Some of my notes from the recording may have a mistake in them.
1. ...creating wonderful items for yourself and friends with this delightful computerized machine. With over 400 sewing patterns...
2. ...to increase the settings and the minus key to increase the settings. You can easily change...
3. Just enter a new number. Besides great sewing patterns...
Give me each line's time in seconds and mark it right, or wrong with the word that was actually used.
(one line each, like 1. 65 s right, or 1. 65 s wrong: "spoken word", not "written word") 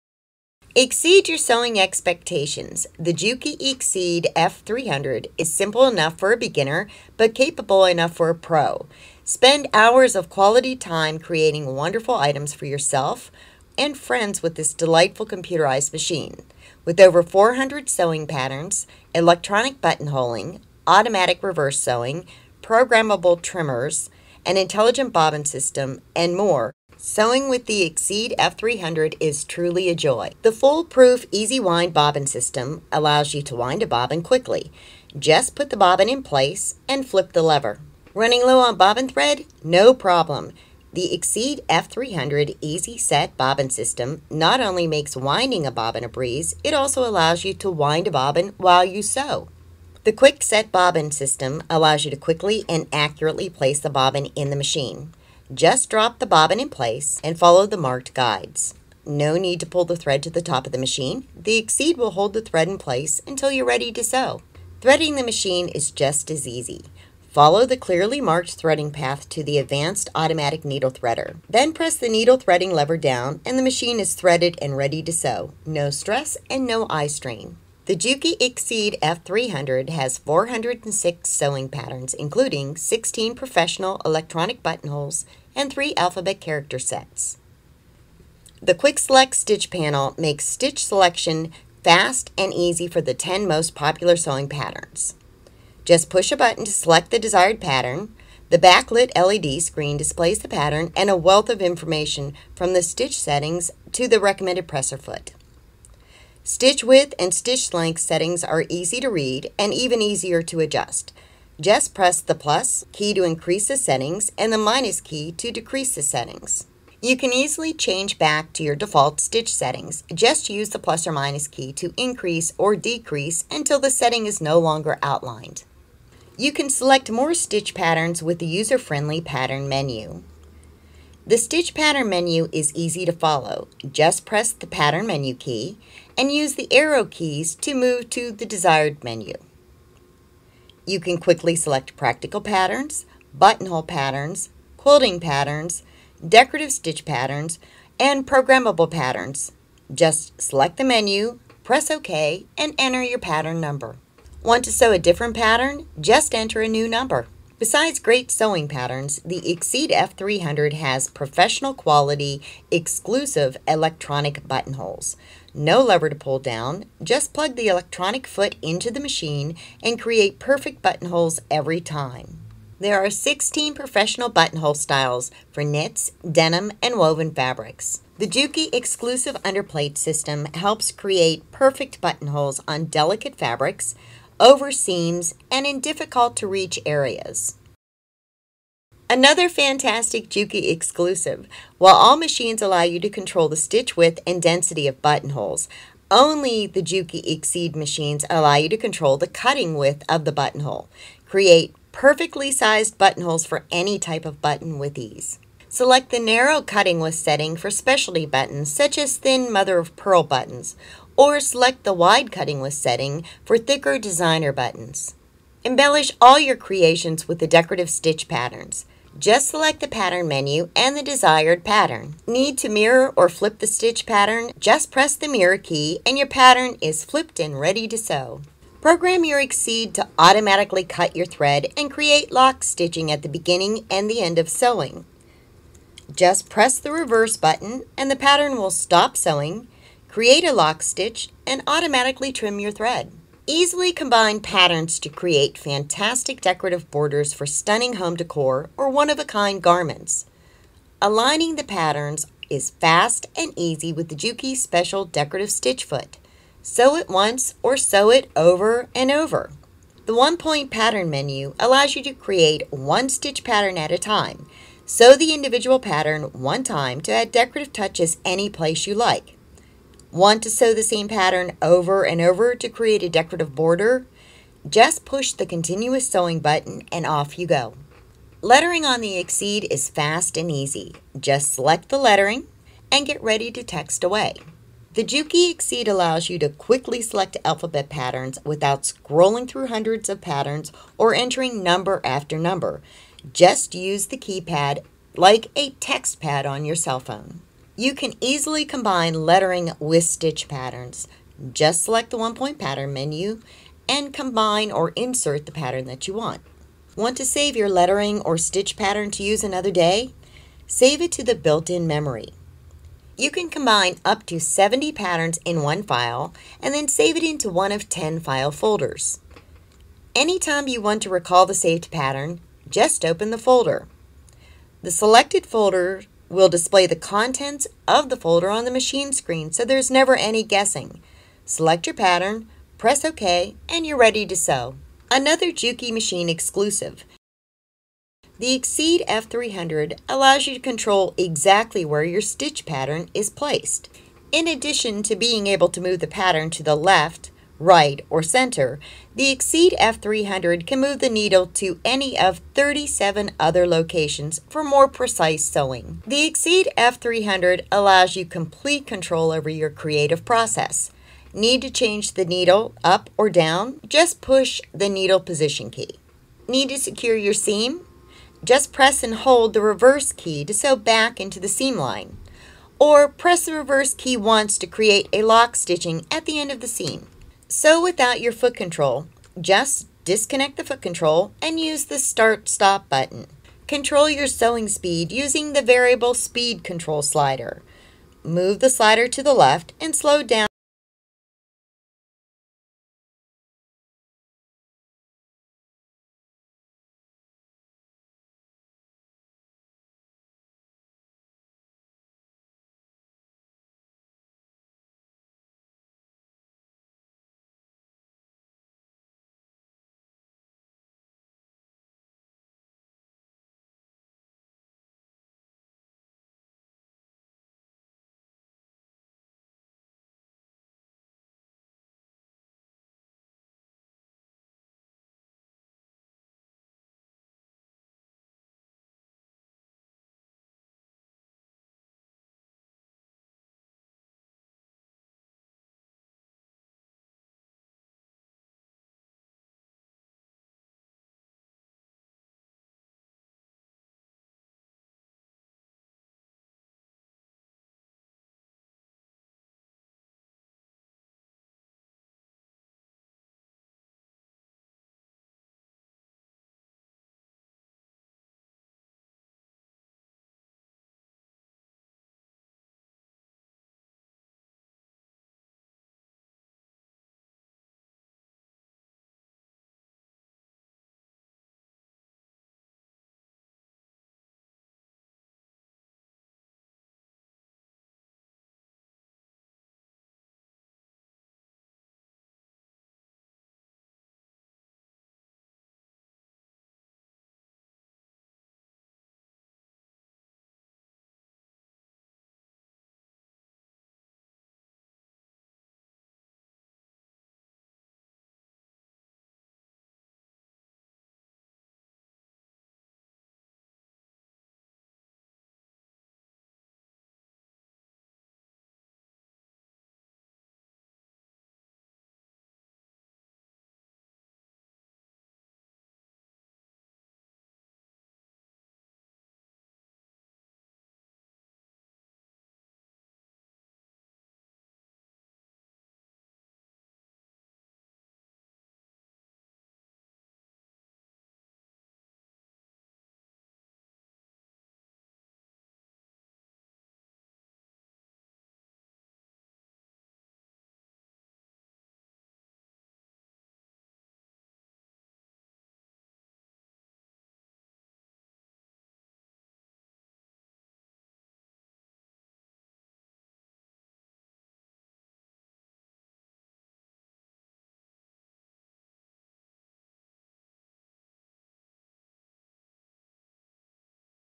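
1. 11 s right
2. 113 s wrong: "decrease", not "increase"
3. 155 s right.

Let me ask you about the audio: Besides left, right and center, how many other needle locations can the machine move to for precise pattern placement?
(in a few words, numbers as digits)
37.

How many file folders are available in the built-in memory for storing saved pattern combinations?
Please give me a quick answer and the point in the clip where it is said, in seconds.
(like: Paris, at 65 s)
10, at 317 s.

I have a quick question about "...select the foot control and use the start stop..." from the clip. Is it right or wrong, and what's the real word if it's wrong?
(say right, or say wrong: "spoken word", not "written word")
wrong: "disconnect", not "select".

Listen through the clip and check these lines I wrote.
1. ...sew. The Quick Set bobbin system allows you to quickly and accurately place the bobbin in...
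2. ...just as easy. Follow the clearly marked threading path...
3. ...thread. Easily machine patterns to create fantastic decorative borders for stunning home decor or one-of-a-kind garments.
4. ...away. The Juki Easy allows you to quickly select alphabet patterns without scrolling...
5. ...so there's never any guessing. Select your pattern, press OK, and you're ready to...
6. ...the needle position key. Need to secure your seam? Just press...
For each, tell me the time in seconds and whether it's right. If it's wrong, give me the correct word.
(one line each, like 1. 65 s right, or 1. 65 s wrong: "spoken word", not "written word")
1. 49 s right
2. 65 s right
3. 242 s wrong: "combine", not "machine"
4. 284 s wrong: "Exceed", not "Easy"
5. 329 s right
6. 364 s right.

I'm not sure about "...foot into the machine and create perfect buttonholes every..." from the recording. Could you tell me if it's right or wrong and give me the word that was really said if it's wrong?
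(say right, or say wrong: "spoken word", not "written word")
right.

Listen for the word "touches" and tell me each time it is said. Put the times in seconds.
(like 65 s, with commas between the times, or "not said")
267 s.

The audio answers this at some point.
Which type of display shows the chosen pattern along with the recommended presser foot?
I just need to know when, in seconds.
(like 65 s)
98 s.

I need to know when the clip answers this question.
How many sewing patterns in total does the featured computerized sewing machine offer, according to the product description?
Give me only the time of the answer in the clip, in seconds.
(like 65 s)
80 s.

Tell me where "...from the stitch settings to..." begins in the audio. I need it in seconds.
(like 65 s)
102 s.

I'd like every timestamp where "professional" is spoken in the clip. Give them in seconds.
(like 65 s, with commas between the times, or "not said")
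83 s, 161 s, 173 s.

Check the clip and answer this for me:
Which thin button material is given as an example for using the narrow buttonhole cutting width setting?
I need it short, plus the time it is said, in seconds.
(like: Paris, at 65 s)
mother of pearl, at 209 s.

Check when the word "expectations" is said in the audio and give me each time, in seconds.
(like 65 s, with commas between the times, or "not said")
1 s.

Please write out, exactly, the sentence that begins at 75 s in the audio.
No stress and no eye strain.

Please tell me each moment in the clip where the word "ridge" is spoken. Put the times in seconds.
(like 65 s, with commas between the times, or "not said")
not said.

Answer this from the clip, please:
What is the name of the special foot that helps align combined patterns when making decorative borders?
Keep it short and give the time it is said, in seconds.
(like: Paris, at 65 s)
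Juki Special Decorative Stitch Foot, at 254 s.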